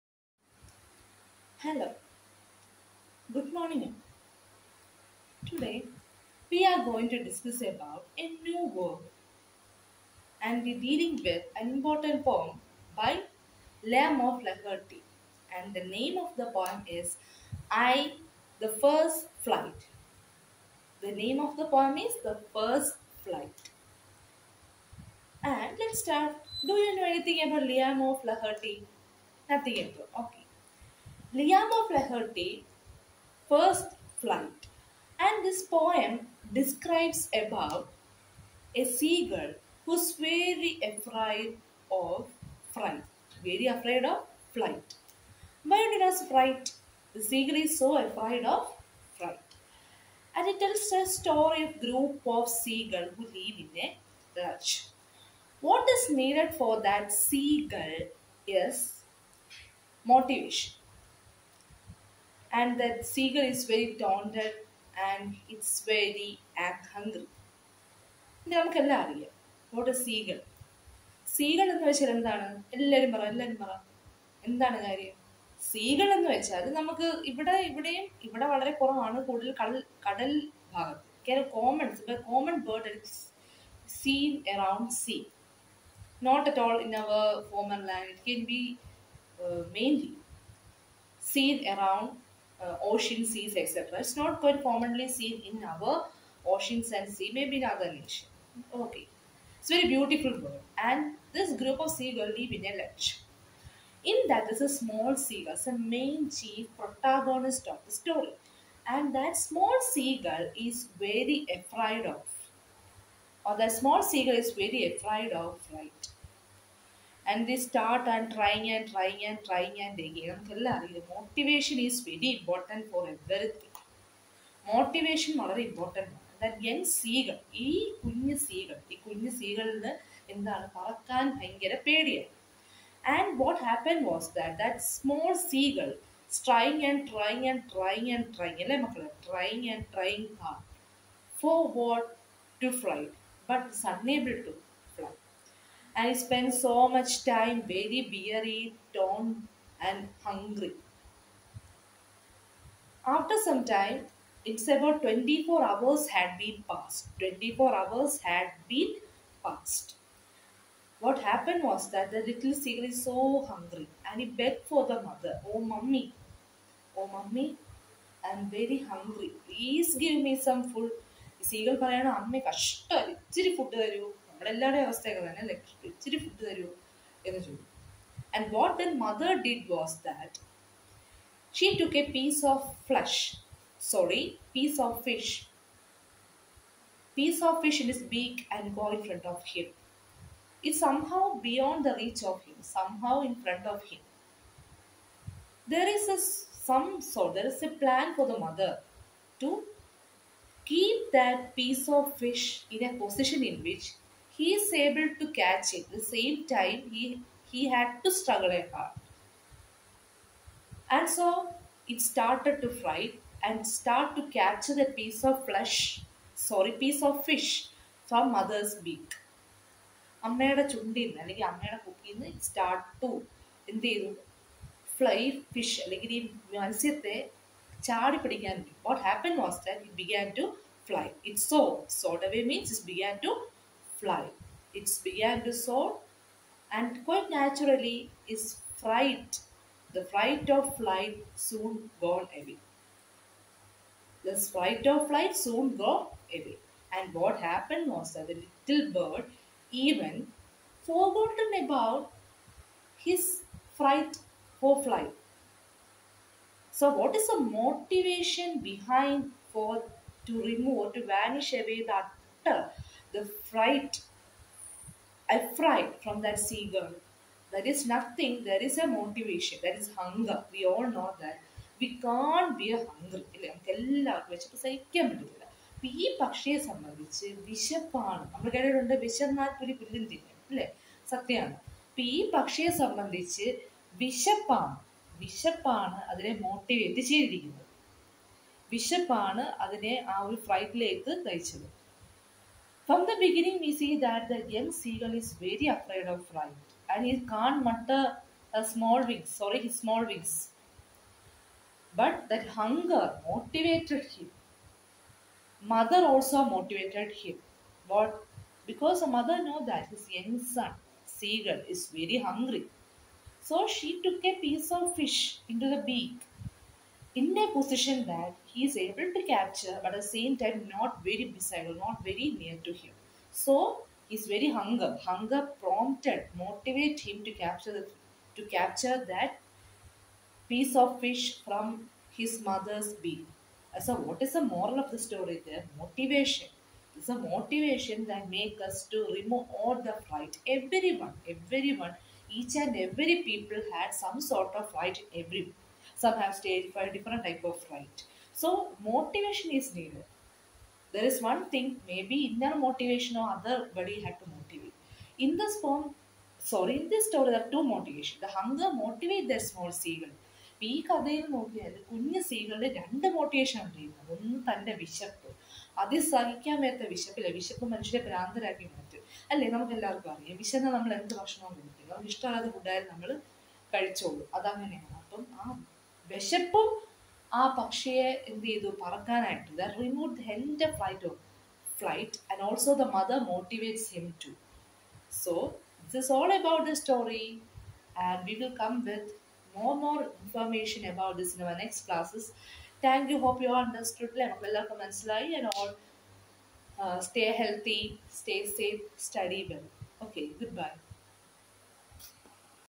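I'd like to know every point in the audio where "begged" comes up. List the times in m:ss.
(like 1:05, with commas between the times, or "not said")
2:44.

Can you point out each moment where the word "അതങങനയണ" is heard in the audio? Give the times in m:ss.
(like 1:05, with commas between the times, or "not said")
6:14.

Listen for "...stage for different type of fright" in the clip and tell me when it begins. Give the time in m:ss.
5:46.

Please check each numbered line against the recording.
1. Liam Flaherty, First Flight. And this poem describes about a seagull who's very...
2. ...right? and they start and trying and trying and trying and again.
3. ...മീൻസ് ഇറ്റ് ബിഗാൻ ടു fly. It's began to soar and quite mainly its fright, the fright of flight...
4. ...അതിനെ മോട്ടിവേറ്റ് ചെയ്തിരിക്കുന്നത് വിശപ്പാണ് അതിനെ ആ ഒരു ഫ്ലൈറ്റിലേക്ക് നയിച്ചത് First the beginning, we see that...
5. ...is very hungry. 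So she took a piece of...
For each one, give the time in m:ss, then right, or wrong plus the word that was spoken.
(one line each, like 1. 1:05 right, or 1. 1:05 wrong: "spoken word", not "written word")
1. 0:31 right
2. 1:55 right
3. 3:52 wrong: "naturally", not "mainly"
4. 4:46 wrong: "From", not "First"
5. 5:11 right.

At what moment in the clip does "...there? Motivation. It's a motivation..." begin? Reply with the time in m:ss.
5:35.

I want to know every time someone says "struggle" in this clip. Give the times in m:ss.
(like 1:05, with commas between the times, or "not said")
3:28.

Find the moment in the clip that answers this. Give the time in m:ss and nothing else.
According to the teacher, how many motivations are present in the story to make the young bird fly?
5:57.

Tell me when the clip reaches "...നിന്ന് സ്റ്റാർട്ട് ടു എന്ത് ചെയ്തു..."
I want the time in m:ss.
3:42.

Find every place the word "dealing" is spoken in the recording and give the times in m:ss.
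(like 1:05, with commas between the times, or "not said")
0:10.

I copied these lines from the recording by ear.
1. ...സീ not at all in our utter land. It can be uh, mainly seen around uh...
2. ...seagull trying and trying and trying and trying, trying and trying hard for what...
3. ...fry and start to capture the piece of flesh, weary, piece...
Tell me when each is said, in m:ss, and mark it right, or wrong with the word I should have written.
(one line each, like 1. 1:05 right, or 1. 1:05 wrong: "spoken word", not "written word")
1. 1:25 wrong: "former", not "utter"
2. 2:15 right
3. 3:32 wrong: "sorry", not "weary".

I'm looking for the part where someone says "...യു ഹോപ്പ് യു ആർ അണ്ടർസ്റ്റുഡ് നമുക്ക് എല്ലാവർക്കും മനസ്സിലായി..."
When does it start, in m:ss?
6:33.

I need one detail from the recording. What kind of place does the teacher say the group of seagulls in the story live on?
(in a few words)
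A ledge.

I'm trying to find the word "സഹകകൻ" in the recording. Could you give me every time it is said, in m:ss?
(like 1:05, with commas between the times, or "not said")
4:34, 6:06.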